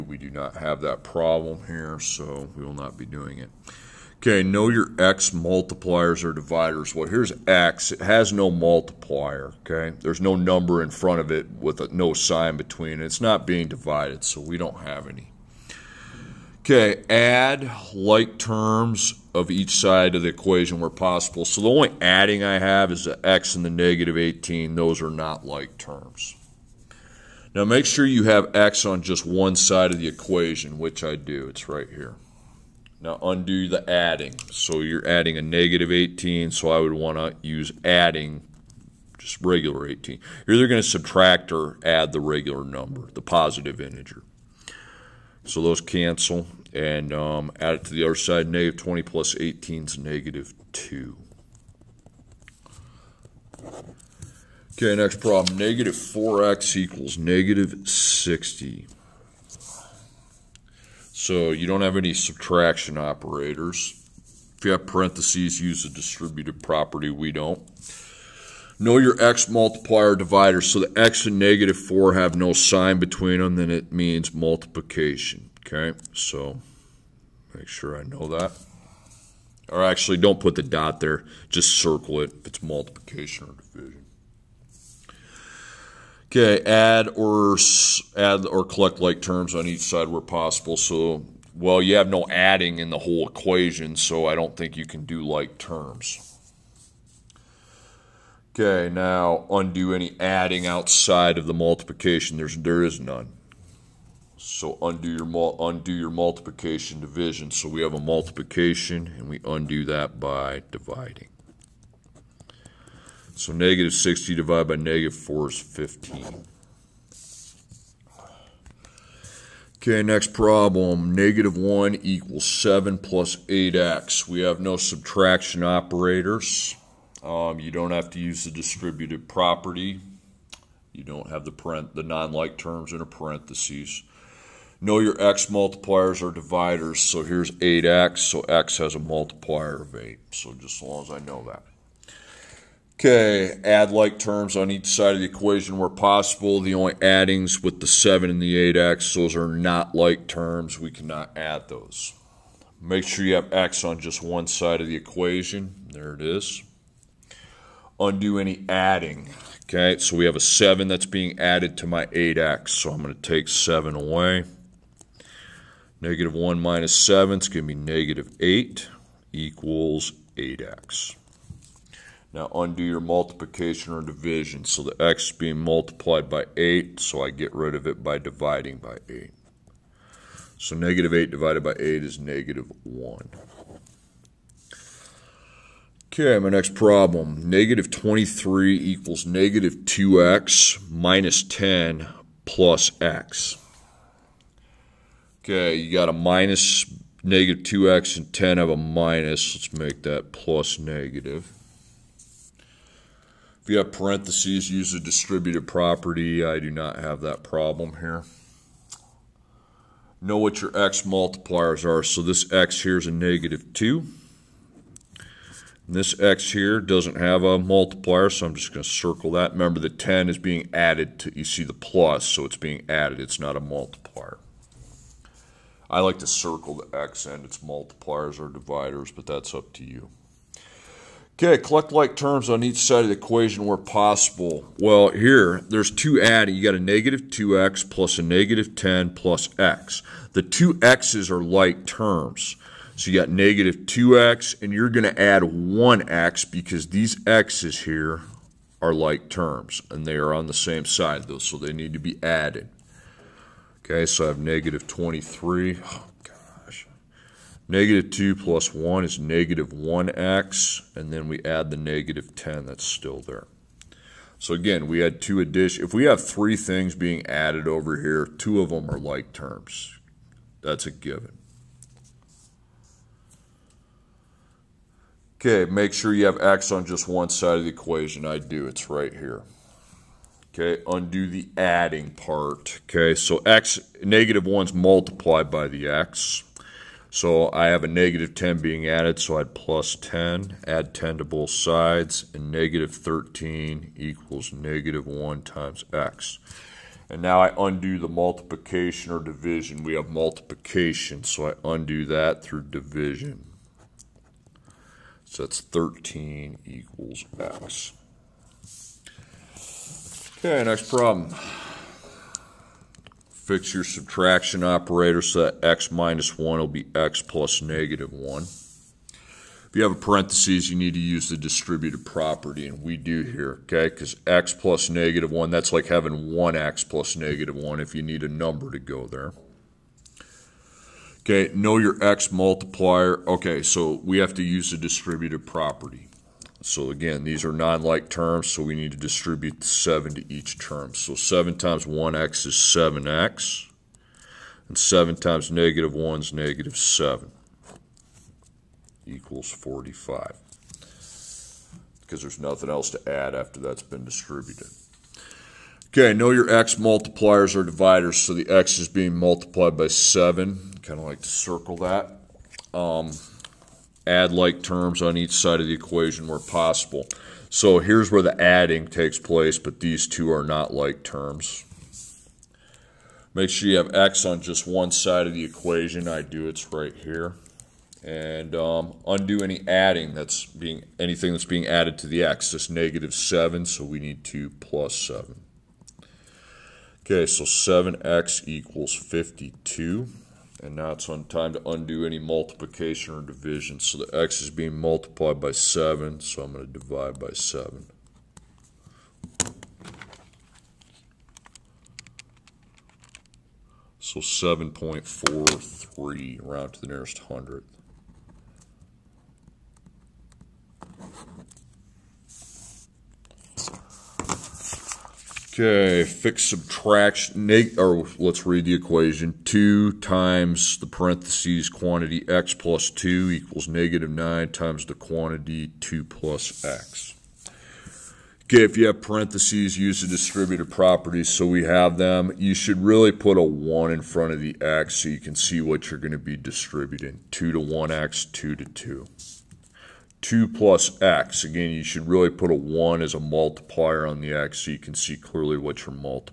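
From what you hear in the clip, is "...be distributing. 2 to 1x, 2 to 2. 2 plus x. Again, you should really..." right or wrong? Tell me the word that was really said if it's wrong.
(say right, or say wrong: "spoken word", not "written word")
right.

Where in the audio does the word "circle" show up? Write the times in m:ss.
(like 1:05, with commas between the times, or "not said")
1:21, 3:38, 3:46, 6:01.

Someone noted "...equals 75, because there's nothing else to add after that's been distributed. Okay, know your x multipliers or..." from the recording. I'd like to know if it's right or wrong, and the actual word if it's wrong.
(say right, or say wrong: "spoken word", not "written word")
wrong: "45", not "75".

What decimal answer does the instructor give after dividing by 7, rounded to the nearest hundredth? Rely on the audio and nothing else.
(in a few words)
7.43.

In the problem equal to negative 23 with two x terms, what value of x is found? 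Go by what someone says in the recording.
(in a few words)
13.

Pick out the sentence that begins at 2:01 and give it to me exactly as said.
Negative 1 equals 7 plus 8x.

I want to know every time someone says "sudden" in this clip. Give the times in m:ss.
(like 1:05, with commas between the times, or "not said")
not said.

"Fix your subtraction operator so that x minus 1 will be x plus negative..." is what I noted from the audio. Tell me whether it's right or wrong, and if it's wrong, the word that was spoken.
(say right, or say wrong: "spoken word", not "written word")
right.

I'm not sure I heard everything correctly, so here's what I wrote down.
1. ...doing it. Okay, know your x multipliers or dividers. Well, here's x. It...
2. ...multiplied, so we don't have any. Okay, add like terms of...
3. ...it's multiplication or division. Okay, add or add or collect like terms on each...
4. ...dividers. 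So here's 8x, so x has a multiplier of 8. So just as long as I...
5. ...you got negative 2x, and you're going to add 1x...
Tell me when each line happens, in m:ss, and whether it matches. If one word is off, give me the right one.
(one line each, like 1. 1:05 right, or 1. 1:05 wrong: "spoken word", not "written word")
1. 0:03 right
2. 0:13 wrong: "divided", not "multiplied"
3. 1:22 right
4. 2:16 right
5. 4:03 right.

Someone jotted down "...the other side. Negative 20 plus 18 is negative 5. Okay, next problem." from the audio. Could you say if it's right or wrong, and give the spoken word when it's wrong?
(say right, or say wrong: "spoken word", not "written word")
wrong: "2", not "5".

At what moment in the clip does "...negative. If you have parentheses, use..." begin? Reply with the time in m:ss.
3:20.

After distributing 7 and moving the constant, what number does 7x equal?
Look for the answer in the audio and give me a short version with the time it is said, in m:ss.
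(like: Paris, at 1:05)
52, at 6:28.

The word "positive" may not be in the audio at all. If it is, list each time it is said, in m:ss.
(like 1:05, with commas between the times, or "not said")
0:43.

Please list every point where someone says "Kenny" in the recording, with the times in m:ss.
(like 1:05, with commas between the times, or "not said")
not said.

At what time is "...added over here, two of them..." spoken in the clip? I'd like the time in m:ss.
4:27.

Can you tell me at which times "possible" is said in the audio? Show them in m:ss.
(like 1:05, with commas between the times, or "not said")
0:20, 1:30, 2:25, 3:53, 6:06.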